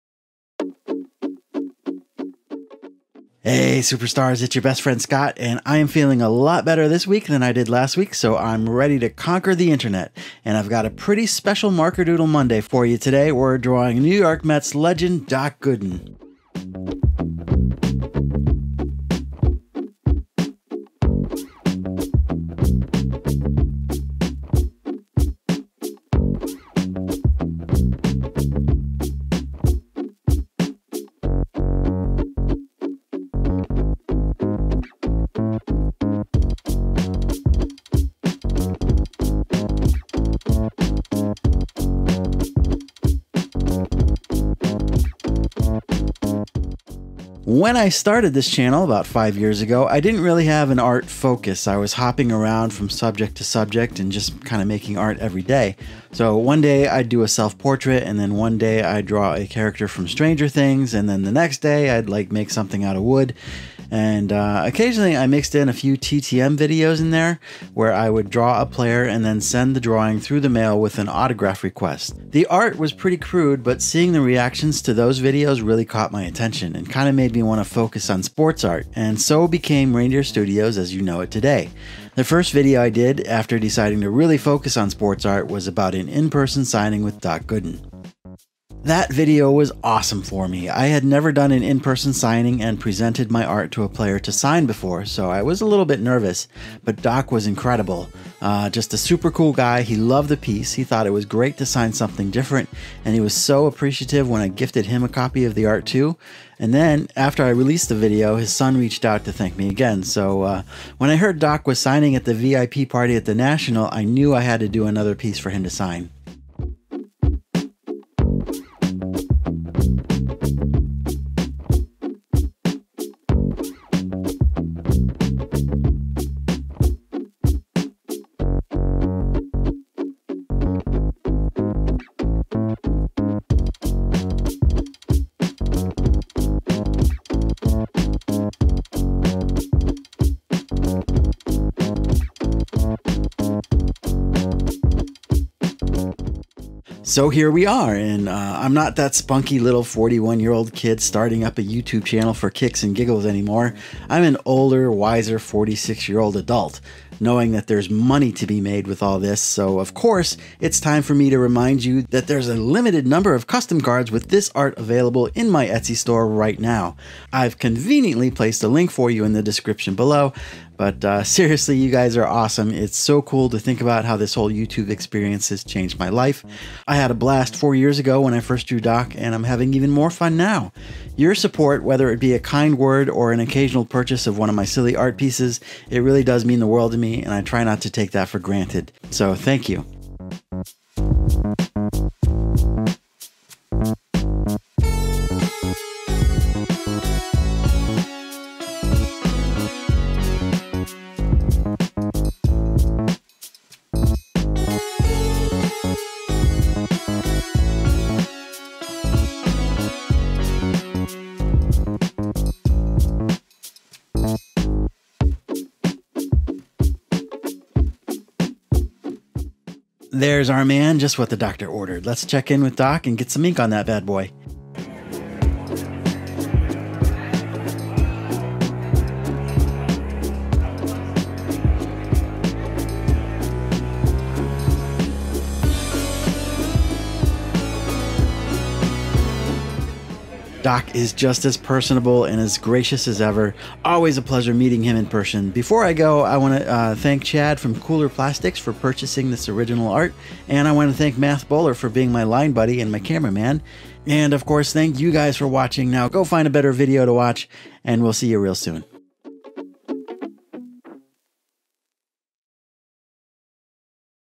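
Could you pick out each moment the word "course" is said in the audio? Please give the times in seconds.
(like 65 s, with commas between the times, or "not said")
159 s, 254 s.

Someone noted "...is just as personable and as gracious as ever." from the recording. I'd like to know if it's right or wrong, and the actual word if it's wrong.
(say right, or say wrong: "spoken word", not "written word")
right.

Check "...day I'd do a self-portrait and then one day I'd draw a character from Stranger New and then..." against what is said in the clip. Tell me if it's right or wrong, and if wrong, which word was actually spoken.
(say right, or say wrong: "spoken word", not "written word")
wrong: "Things", not "New".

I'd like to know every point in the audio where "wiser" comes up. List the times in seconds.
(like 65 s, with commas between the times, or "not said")
154 s.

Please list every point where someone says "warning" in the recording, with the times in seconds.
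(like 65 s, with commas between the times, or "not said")
not said.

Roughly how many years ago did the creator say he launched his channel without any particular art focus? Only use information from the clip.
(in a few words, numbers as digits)
5 years.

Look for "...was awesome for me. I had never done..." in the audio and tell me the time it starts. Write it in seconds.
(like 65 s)
89 s.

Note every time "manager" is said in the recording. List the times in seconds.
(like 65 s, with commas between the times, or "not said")
not said.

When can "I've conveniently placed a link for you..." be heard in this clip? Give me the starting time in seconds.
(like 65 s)
167 s.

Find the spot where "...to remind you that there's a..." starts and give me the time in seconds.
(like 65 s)
161 s.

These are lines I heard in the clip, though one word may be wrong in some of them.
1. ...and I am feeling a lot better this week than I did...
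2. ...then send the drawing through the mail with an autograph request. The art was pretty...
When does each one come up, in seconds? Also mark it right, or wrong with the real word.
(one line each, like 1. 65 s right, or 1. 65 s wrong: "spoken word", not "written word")
1. 5 s right
2. 69 s right.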